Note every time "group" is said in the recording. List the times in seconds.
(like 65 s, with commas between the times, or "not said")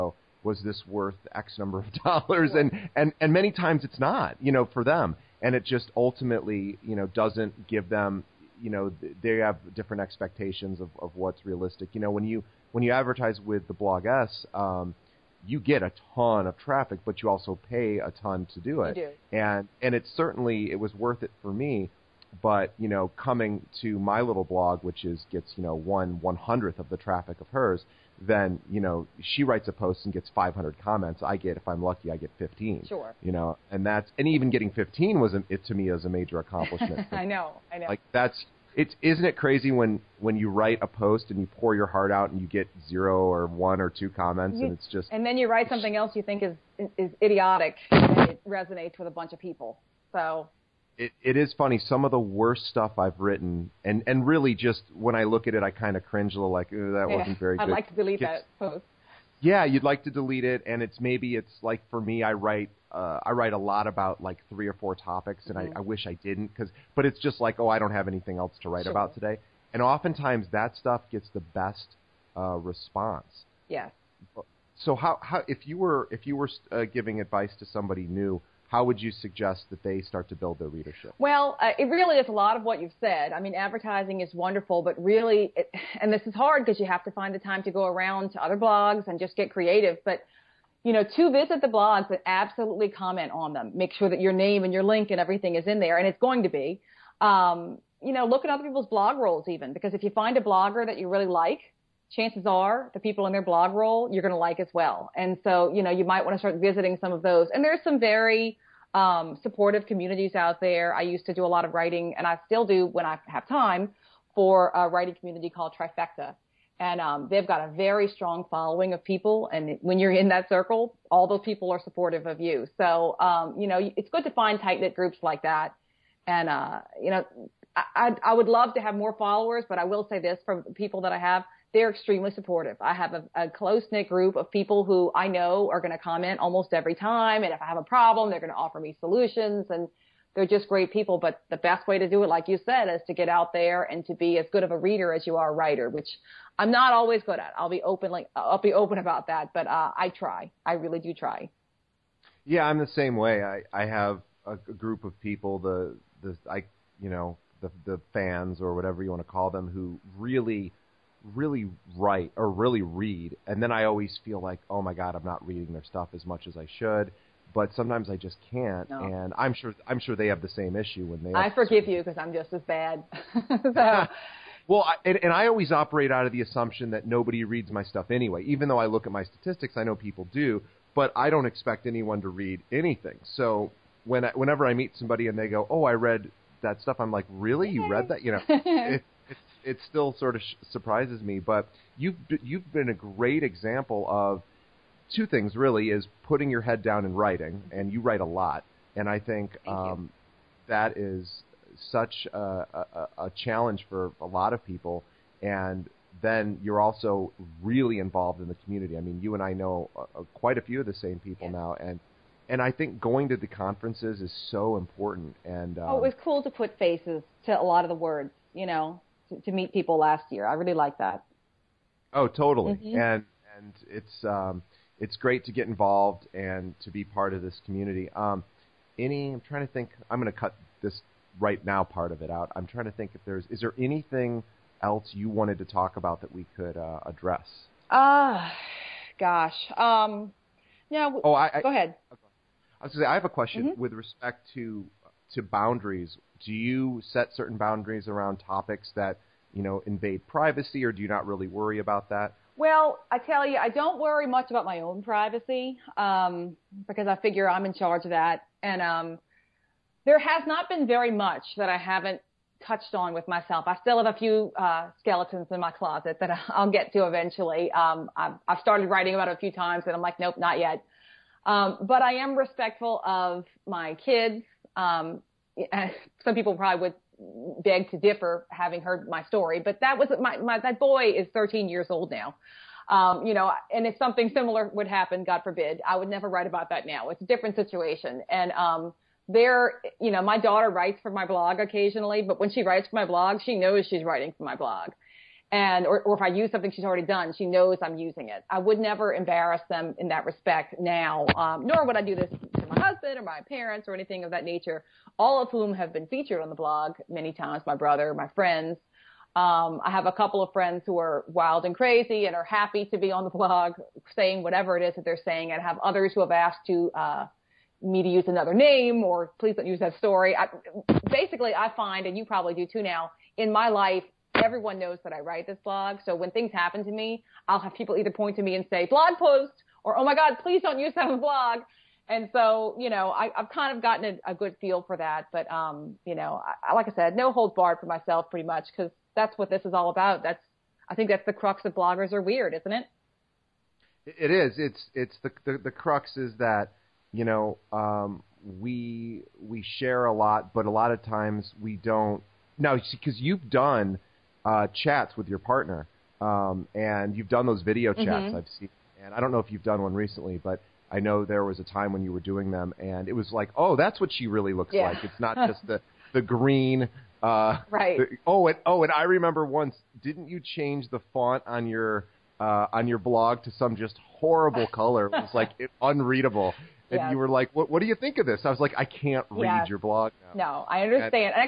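124 s, 134 s, 154 s.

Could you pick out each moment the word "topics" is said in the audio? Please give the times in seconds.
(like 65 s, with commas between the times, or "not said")
64 s, 248 s.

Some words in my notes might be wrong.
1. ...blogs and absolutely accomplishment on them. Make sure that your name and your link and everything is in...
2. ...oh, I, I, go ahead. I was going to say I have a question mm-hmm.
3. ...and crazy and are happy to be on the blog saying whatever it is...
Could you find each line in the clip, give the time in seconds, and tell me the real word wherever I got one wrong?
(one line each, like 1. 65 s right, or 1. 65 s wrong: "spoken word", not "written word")
1. 91 s wrong: "comment", not "accomplishment"
2. 241 s right
3. 311 s right.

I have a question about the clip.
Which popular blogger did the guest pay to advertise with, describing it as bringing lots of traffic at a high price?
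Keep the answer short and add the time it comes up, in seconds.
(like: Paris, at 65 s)
The Bloggess, at 13 s.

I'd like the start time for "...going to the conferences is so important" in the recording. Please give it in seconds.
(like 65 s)
212 s.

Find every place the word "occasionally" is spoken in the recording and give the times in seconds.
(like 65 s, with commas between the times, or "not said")
291 s.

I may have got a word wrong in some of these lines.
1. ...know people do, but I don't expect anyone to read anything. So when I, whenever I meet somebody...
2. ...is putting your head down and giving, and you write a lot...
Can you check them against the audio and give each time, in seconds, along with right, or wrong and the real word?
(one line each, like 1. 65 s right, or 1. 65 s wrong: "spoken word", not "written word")
1. 179 s right
2. 195 s wrong: "writing", not "giving".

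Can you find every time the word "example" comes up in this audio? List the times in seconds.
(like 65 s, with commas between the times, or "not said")
193 s.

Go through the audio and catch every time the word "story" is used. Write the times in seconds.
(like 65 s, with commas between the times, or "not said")
279 s, 319 s.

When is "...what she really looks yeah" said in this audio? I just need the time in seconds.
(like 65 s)
364 s.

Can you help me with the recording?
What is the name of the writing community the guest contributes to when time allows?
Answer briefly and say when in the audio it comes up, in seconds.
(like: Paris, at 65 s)
Trifecta, at 115 s.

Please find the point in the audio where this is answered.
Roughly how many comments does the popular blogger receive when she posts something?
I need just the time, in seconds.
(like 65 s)
30 s.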